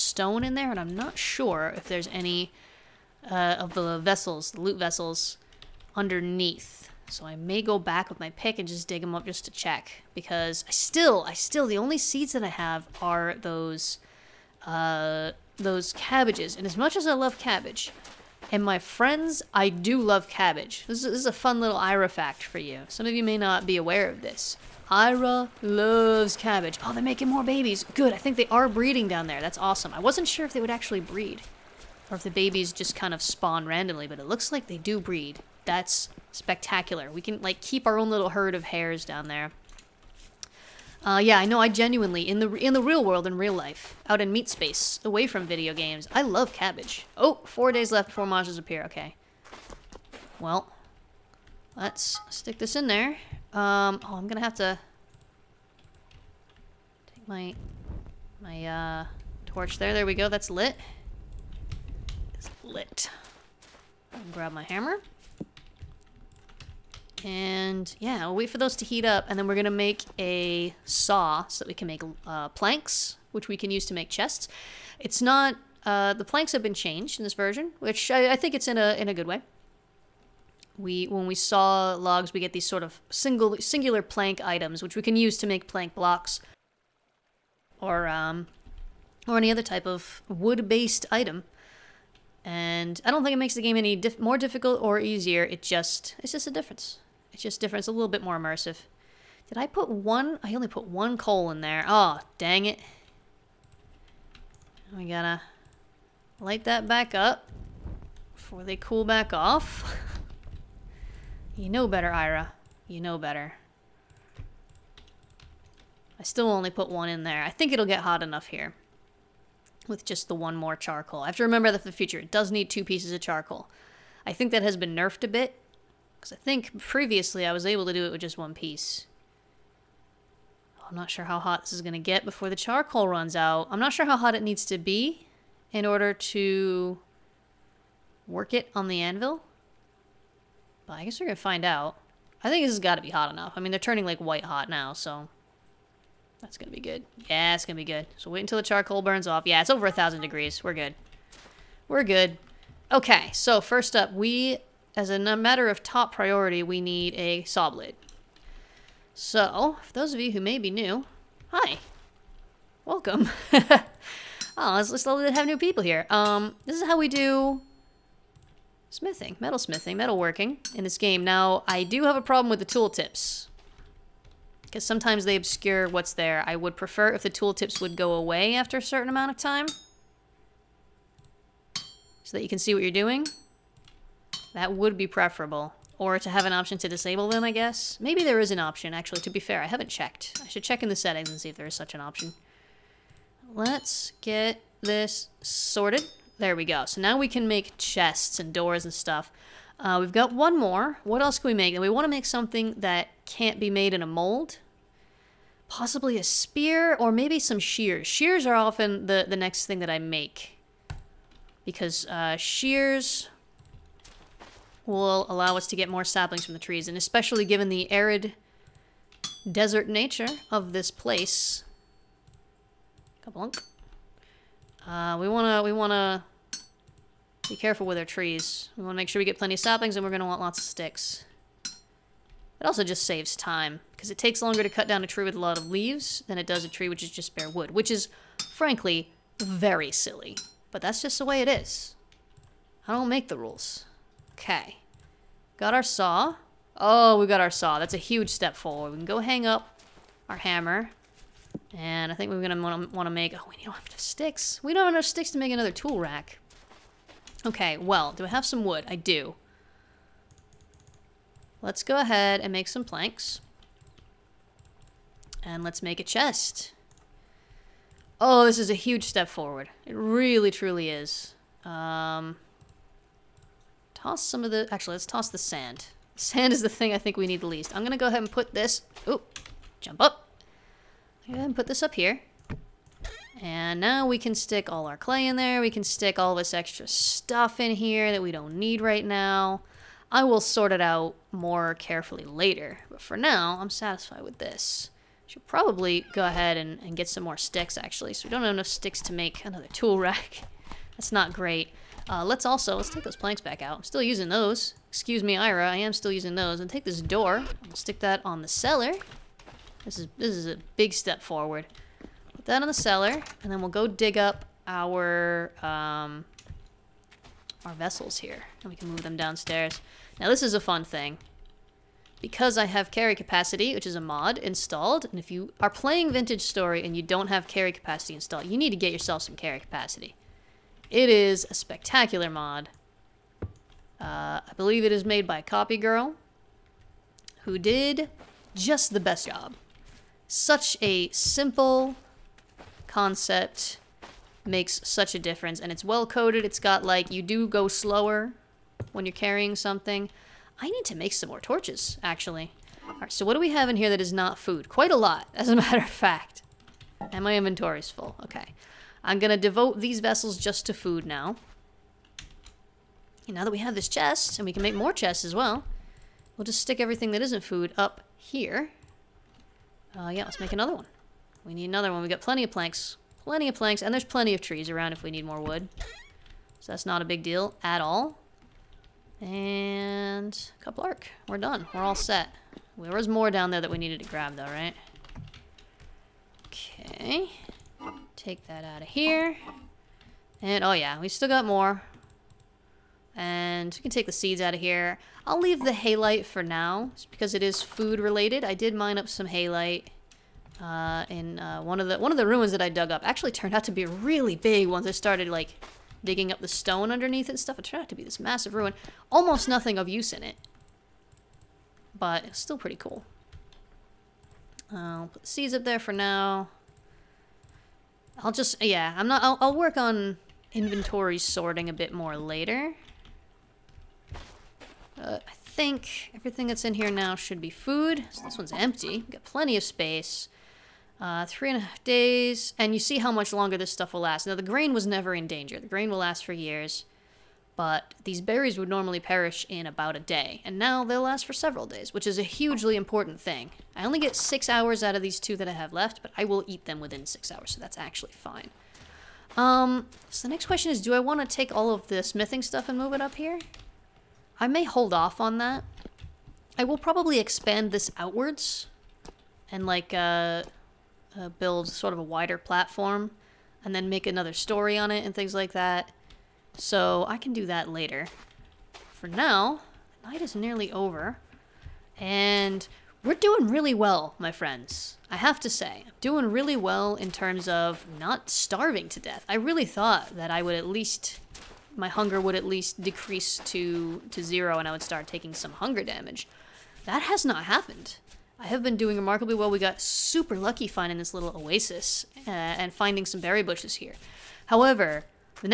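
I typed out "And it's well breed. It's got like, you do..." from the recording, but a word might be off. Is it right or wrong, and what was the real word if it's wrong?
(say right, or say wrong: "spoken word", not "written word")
wrong: "coded", not "breed".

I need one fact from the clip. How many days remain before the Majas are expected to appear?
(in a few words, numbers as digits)
4.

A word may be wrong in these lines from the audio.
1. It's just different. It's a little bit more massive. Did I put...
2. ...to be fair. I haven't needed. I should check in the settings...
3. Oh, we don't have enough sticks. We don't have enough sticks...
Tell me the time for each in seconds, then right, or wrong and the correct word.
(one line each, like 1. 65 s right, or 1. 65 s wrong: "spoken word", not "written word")
1. 97 s wrong: "immersive", not "massive"
2. 189 s wrong: "checked", not "needed"
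3. 253 s right.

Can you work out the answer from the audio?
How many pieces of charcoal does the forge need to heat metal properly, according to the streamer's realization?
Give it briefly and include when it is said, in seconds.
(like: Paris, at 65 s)
2, at 122 s.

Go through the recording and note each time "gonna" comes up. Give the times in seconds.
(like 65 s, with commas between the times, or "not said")
54 s, 69 s, 230 s, 252 s.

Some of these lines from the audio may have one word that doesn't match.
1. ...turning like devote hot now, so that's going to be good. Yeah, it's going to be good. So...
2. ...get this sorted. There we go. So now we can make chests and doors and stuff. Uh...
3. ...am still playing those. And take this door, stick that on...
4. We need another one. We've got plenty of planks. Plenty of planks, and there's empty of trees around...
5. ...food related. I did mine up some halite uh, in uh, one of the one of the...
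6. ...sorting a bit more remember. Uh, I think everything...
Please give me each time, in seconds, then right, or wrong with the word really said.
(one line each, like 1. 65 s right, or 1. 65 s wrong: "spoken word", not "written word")
1. 143 s wrong: "white", not "devote"
2. 194 s right
3. 305 s wrong: "using", not "playing"
4. 371 s wrong: "plenty", not "empty"
5. 397 s right
6. 421 s wrong: "later", not "remember".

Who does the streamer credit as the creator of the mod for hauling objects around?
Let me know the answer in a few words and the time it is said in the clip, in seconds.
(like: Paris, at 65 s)
copygirl, at 335 s.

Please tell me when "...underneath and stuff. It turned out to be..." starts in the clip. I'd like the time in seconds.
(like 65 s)
406 s.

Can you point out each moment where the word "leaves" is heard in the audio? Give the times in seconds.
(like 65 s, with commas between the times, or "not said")
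235 s, 395 s.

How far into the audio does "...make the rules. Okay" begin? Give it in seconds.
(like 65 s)
243 s.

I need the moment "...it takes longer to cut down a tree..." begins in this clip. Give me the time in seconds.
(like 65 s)
234 s.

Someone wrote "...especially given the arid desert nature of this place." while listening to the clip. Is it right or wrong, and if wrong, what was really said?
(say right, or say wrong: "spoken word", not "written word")
right.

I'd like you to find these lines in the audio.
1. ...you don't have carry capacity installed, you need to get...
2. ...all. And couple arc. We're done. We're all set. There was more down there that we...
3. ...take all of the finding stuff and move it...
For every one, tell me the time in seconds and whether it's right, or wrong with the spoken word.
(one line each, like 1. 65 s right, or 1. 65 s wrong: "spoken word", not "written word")
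1. 326 s right
2. 377 s right
3. 451 s wrong: "smithing", not "finding".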